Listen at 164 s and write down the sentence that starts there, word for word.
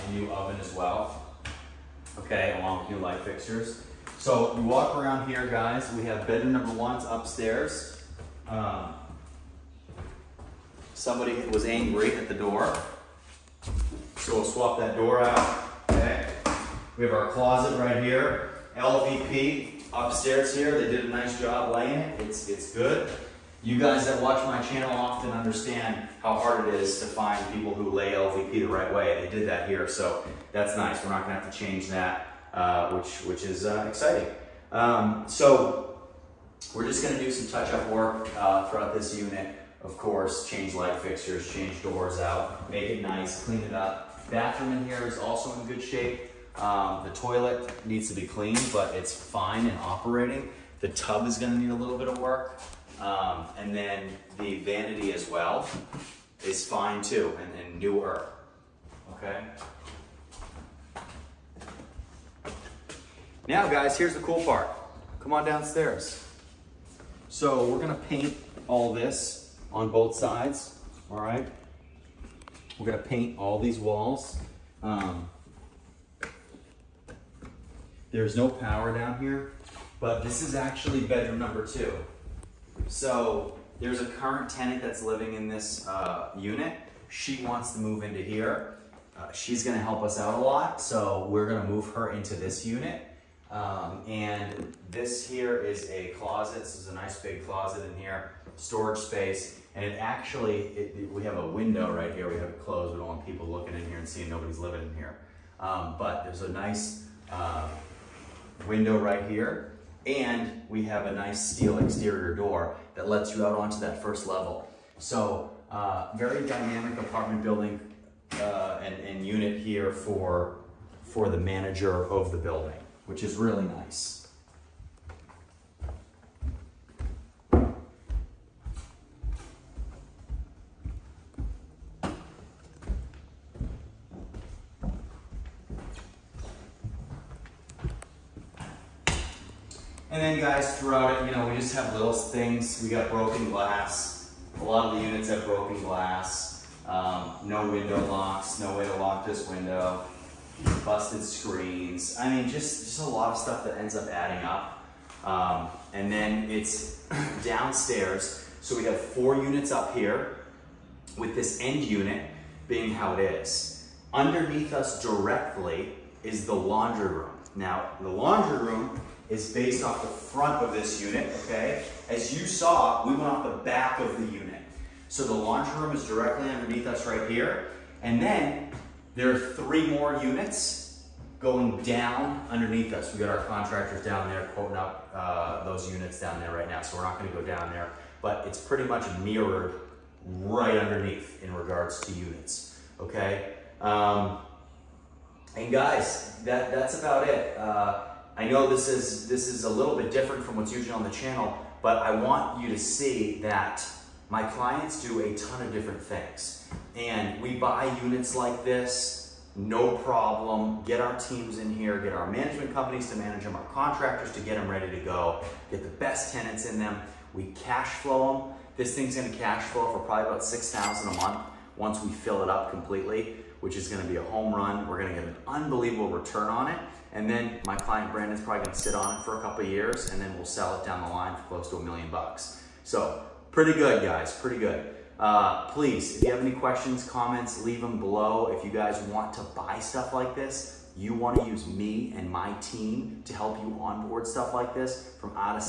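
Underneath us directly is the laundry room.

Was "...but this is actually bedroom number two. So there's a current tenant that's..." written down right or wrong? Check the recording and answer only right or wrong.
right.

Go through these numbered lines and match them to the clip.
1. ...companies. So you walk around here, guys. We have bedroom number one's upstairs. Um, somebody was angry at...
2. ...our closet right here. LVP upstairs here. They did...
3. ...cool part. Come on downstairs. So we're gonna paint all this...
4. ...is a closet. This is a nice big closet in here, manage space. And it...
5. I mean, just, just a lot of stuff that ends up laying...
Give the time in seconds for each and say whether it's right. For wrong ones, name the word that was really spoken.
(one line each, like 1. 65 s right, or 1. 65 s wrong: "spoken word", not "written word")
1. 3 s wrong: "fixtures", not "companies"
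2. 17 s right
3. 64 s right
4. 95 s wrong: "storage", not "manage"
5. 152 s wrong: "adding", not "laying".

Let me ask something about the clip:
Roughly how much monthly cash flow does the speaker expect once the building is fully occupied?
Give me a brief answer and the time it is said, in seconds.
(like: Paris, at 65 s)
6,000, at 220 s.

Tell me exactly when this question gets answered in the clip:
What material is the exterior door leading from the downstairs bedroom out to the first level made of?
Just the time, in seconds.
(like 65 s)
111 s.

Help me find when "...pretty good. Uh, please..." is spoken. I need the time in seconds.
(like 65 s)
234 s.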